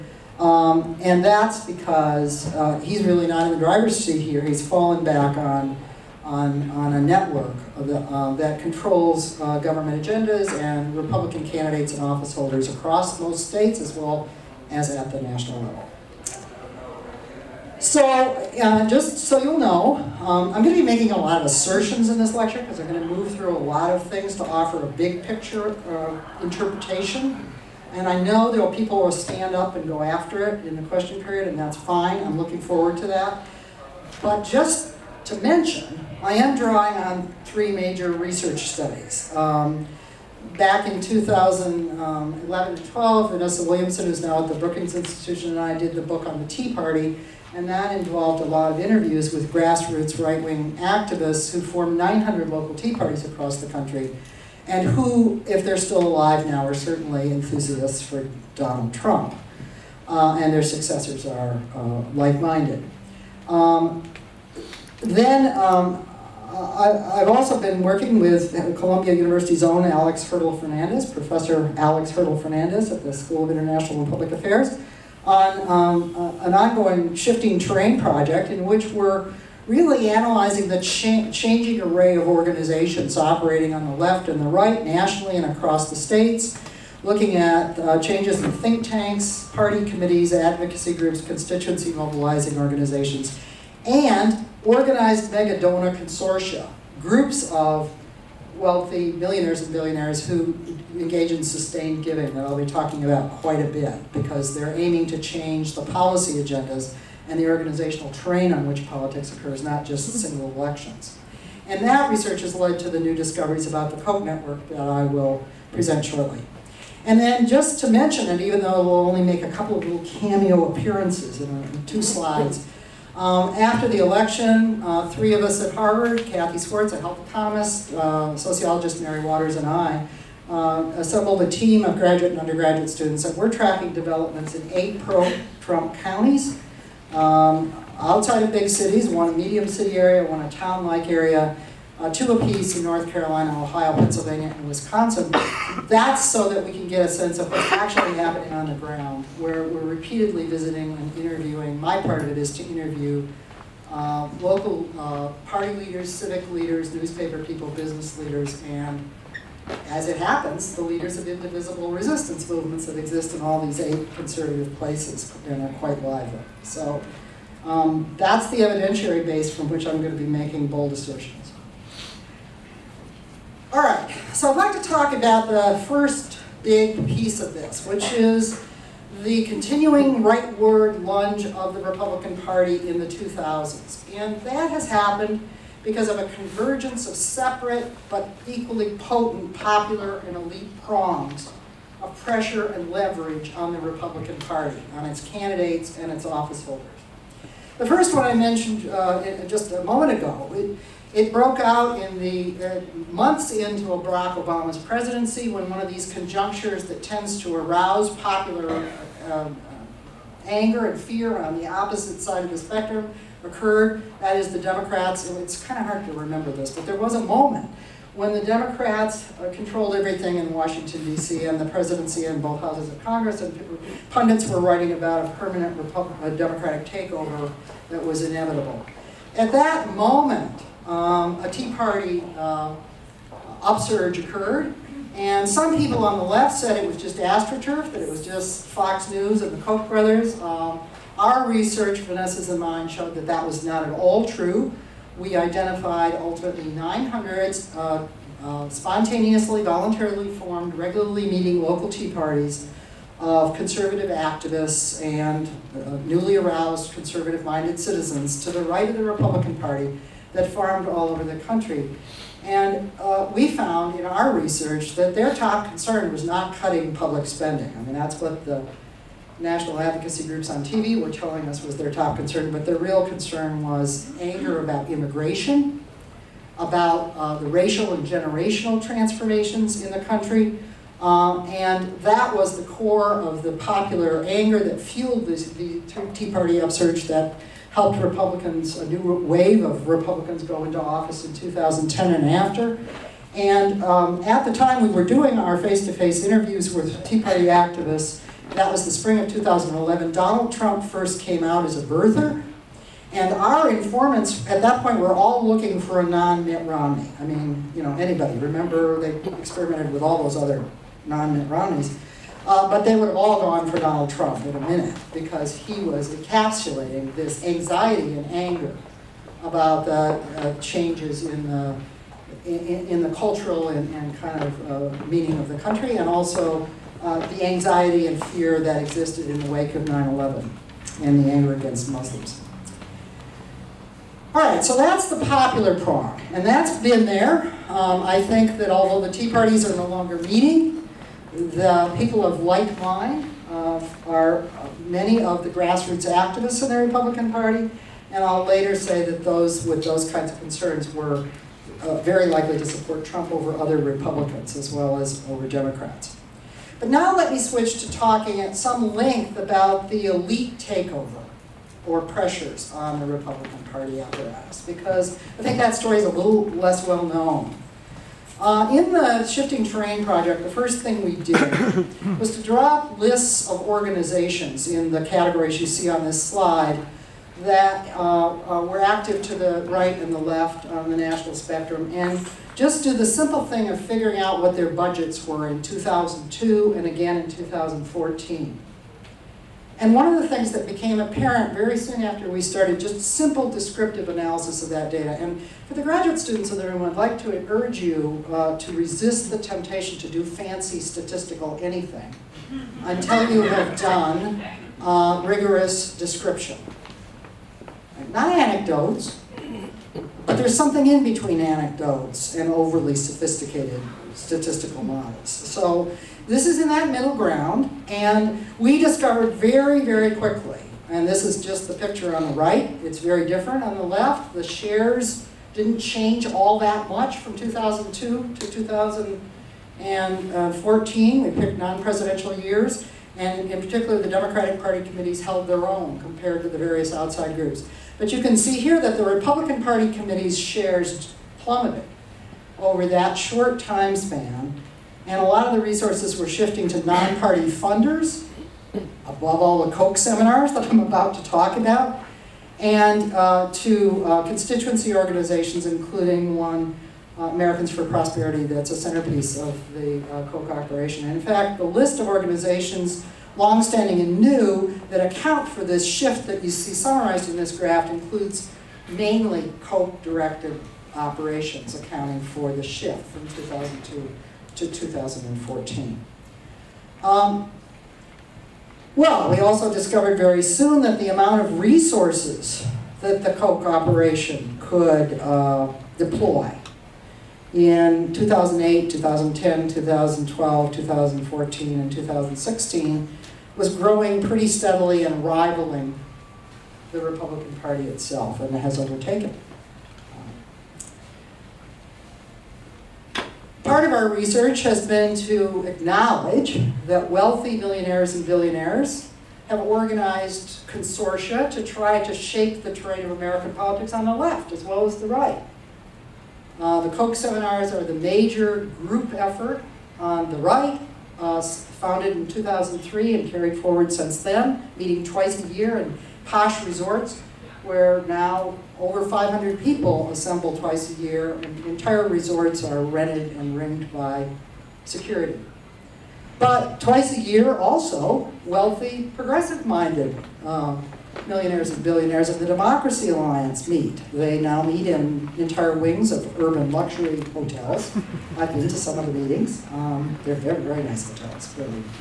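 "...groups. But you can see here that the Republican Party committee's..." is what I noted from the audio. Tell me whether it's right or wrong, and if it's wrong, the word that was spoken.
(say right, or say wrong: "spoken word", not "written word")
right.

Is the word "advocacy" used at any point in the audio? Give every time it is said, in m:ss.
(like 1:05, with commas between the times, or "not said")
1:30, 4:29.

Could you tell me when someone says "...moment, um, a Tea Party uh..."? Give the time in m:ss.
3:49.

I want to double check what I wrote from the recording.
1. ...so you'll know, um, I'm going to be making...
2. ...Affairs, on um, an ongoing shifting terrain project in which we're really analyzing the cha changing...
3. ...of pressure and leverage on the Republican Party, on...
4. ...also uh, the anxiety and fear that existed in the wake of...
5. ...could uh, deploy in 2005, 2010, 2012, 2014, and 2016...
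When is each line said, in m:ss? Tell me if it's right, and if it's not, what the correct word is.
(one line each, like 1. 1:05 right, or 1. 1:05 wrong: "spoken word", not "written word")
1. 0:19 right
2. 1:14 right
3. 3:11 right
4. 5:26 right
5. 8:04 wrong: "2008", not "2005".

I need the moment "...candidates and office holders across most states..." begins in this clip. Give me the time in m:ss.
0:11.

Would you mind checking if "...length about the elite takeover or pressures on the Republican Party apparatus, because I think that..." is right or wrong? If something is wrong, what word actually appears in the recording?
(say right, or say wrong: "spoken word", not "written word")
right.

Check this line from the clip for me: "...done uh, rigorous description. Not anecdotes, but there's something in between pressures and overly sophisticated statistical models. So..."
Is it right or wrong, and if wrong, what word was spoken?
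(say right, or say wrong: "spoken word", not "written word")
wrong: "anecdotes", not "pressures".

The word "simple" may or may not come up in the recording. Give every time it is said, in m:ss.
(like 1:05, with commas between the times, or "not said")
6:23, 6:33.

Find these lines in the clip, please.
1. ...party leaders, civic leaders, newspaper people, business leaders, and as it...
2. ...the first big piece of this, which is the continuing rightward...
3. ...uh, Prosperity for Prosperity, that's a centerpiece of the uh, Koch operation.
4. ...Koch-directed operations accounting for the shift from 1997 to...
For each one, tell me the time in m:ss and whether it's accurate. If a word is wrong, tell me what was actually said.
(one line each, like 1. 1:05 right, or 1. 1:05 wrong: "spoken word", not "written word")
1. 2:35 right
2. 2:55 right
3. 7:37 wrong: "Americans", not "Prosperity"
4. 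7:49 wrong: "2002", not "1997".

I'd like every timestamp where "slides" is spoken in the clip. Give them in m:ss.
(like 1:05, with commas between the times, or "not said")
2:02, 6:16.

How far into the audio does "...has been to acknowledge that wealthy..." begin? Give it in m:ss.
8:24.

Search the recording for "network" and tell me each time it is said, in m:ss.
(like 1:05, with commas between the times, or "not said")
0:07, 1:54.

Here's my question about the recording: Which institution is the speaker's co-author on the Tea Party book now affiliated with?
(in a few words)
Brookings Institution.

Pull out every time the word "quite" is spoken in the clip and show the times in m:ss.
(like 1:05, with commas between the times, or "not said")
1:43, 2:45.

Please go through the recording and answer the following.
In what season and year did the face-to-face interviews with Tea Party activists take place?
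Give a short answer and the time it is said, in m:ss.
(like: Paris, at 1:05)
spring of 2011, at 4:58.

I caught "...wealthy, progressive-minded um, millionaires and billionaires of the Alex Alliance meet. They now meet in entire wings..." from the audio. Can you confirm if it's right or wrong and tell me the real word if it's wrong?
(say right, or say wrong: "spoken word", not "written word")
wrong: "Democracy", not "Alex".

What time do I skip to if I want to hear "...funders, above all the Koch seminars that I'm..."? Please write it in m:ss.
7:27.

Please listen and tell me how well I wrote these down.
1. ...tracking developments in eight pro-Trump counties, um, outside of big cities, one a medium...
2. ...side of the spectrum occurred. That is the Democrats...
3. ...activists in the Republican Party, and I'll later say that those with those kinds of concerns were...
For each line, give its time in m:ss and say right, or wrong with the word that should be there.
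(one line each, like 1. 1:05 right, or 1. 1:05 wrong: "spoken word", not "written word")
1. 2:13 right
2. 3:32 right
3. 5:46 right.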